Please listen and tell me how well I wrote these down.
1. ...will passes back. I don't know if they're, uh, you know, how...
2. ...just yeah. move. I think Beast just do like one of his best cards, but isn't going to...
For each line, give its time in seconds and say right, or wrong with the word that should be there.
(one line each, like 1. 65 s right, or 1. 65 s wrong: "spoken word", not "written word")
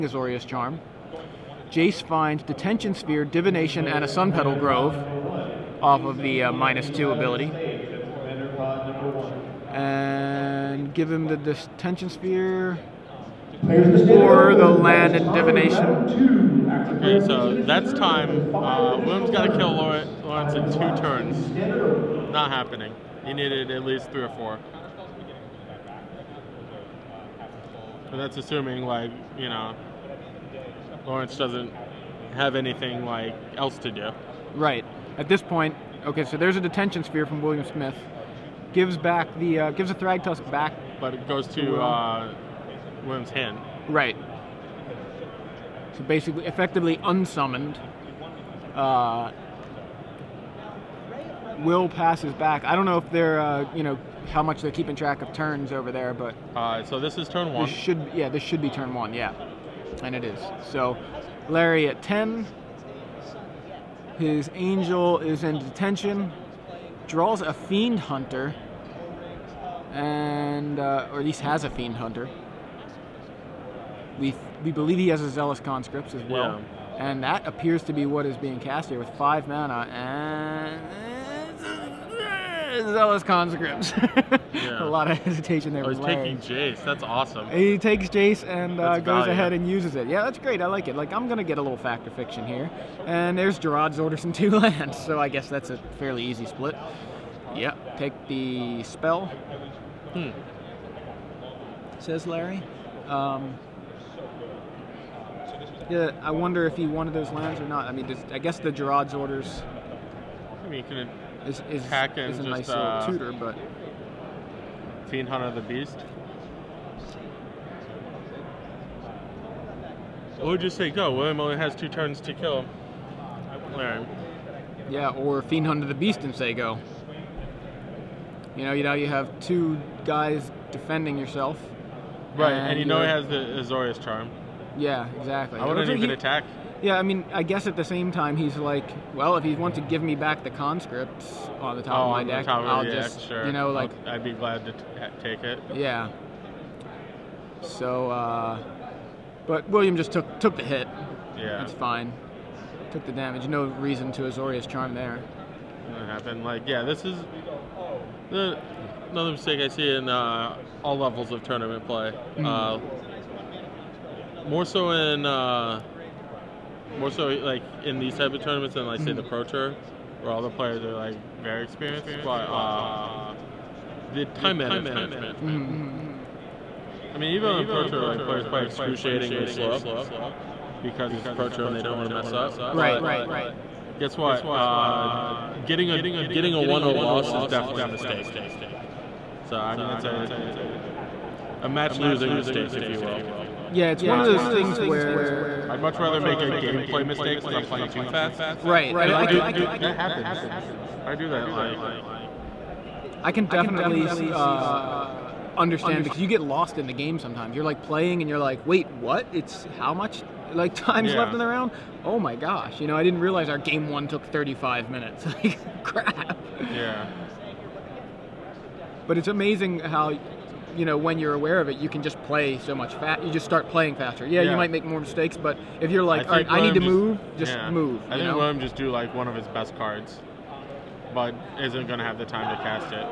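1. 51 s right
2. 227 s wrong: "William", not "Beast".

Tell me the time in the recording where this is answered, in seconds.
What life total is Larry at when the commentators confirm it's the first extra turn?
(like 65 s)
62 s.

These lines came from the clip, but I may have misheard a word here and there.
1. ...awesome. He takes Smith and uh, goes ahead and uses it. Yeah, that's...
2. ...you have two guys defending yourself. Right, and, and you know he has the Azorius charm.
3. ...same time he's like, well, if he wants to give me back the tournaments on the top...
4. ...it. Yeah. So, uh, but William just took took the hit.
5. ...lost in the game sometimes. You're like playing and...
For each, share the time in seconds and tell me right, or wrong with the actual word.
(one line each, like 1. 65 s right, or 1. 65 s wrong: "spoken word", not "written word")
1. 87 s wrong: "Jace", not "Smith"
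2. 128 s right
3. 137 s wrong: "conscripts", not "tournaments"
4. 145 s right
5. 206 s right.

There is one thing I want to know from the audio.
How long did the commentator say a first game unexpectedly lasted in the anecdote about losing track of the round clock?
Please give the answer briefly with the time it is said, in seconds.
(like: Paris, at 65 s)
35 minutes, at 214 s.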